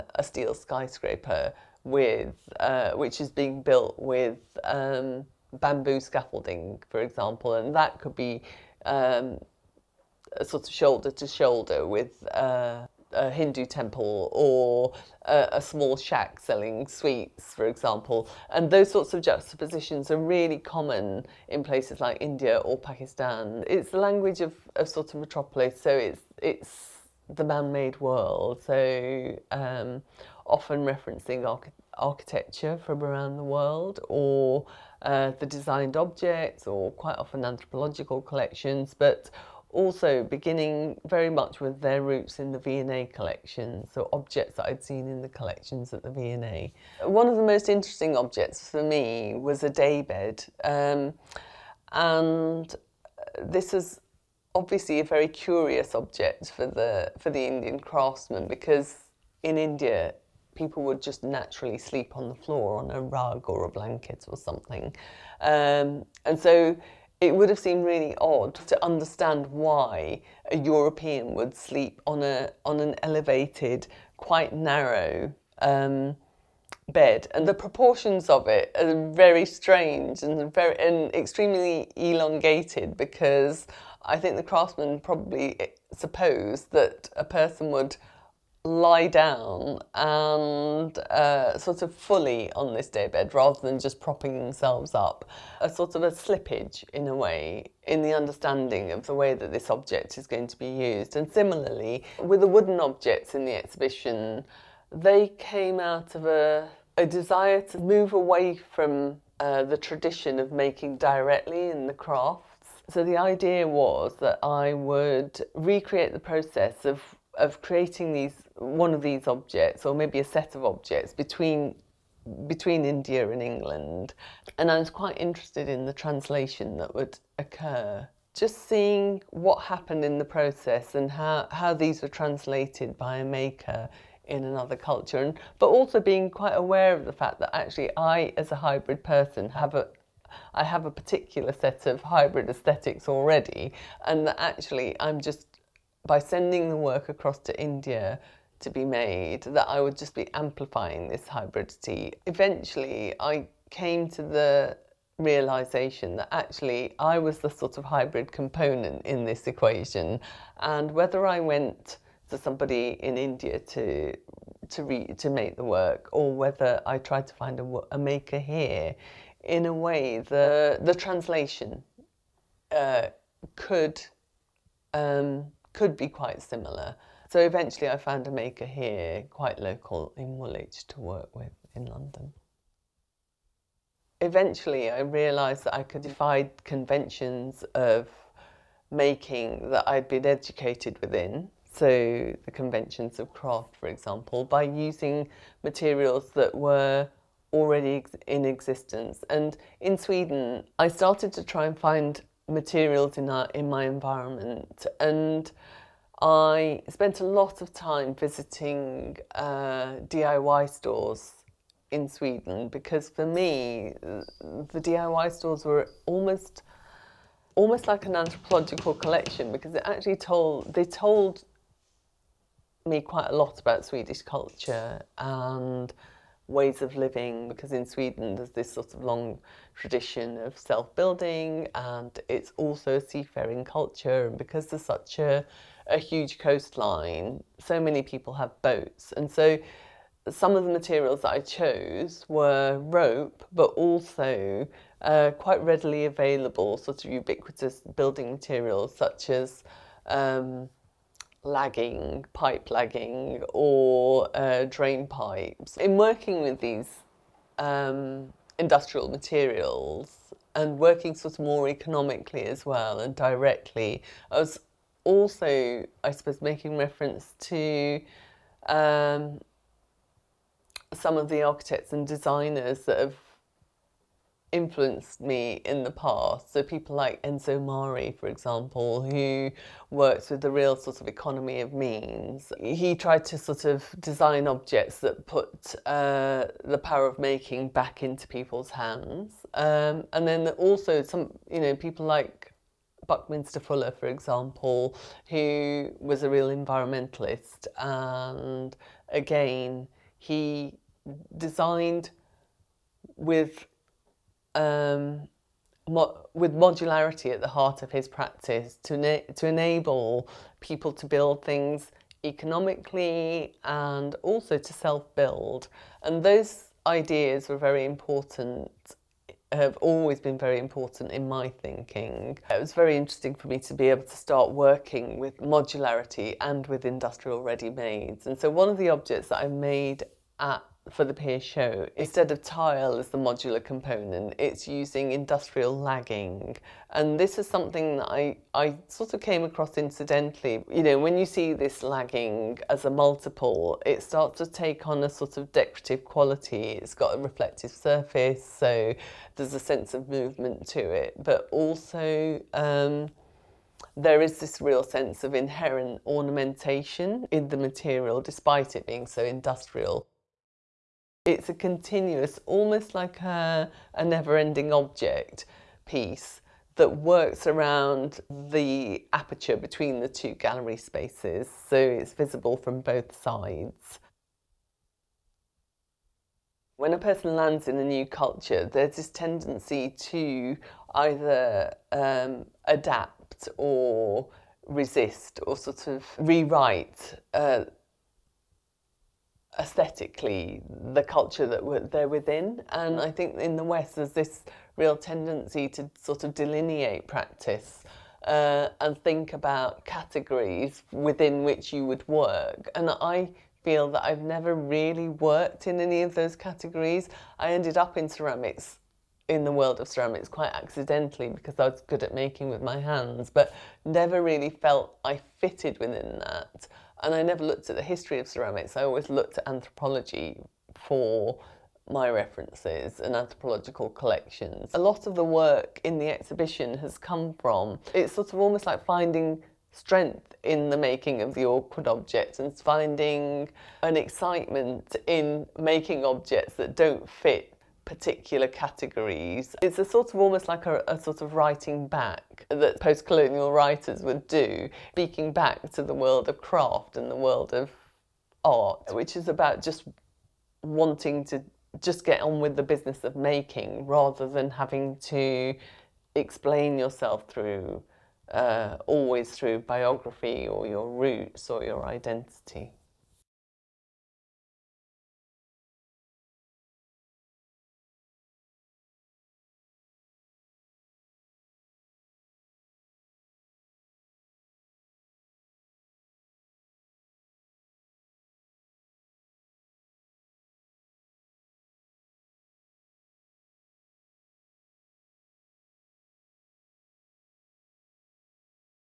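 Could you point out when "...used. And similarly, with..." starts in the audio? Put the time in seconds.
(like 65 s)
100 s.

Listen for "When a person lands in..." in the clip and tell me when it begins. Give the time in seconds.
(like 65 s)
376 s.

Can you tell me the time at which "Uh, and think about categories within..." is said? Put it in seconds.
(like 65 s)
398 s.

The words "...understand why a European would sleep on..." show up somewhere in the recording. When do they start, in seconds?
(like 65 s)
68 s.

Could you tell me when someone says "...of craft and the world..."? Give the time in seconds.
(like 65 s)
446 s.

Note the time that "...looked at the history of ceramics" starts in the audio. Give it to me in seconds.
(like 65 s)
417 s.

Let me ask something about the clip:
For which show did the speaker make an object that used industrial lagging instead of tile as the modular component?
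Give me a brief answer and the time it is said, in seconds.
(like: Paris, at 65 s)
PEER, at 331 s.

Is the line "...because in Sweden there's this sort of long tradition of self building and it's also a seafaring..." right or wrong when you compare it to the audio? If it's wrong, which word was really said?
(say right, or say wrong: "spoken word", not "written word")
right.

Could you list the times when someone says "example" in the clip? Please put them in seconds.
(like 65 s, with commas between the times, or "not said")
7 s, 17 s, 193 s, 278 s, 294 s.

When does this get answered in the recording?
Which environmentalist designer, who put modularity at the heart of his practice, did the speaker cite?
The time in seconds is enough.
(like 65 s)
293 s.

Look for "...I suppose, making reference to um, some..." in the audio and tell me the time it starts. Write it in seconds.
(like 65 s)
266 s.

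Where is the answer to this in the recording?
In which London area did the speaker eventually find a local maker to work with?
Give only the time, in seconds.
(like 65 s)
180 s.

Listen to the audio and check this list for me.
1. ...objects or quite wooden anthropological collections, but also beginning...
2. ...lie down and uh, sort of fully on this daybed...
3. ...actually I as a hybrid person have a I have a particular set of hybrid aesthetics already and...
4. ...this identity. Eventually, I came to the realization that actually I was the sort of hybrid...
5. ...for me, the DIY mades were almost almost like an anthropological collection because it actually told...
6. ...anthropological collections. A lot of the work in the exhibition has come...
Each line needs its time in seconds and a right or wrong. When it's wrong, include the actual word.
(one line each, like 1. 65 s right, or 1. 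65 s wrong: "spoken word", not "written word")
1. 35 s wrong: "often", not "wooden"
2. 88 s right
3. 137 s right
4. 151 s wrong: "hybridity", not "identity"
5. 213 s wrong: "stores", not "mades"
6. 423 s right.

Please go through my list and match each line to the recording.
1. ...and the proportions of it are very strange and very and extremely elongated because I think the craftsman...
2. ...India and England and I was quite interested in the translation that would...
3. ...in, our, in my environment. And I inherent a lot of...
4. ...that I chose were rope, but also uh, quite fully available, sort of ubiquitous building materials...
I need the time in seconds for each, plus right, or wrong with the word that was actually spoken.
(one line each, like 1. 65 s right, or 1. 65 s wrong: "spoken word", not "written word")
1. 77 s right
2. 122 s right
3. 203 s wrong: "spent", not "inherent"
4. 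241 s wrong: "readily", not "fully".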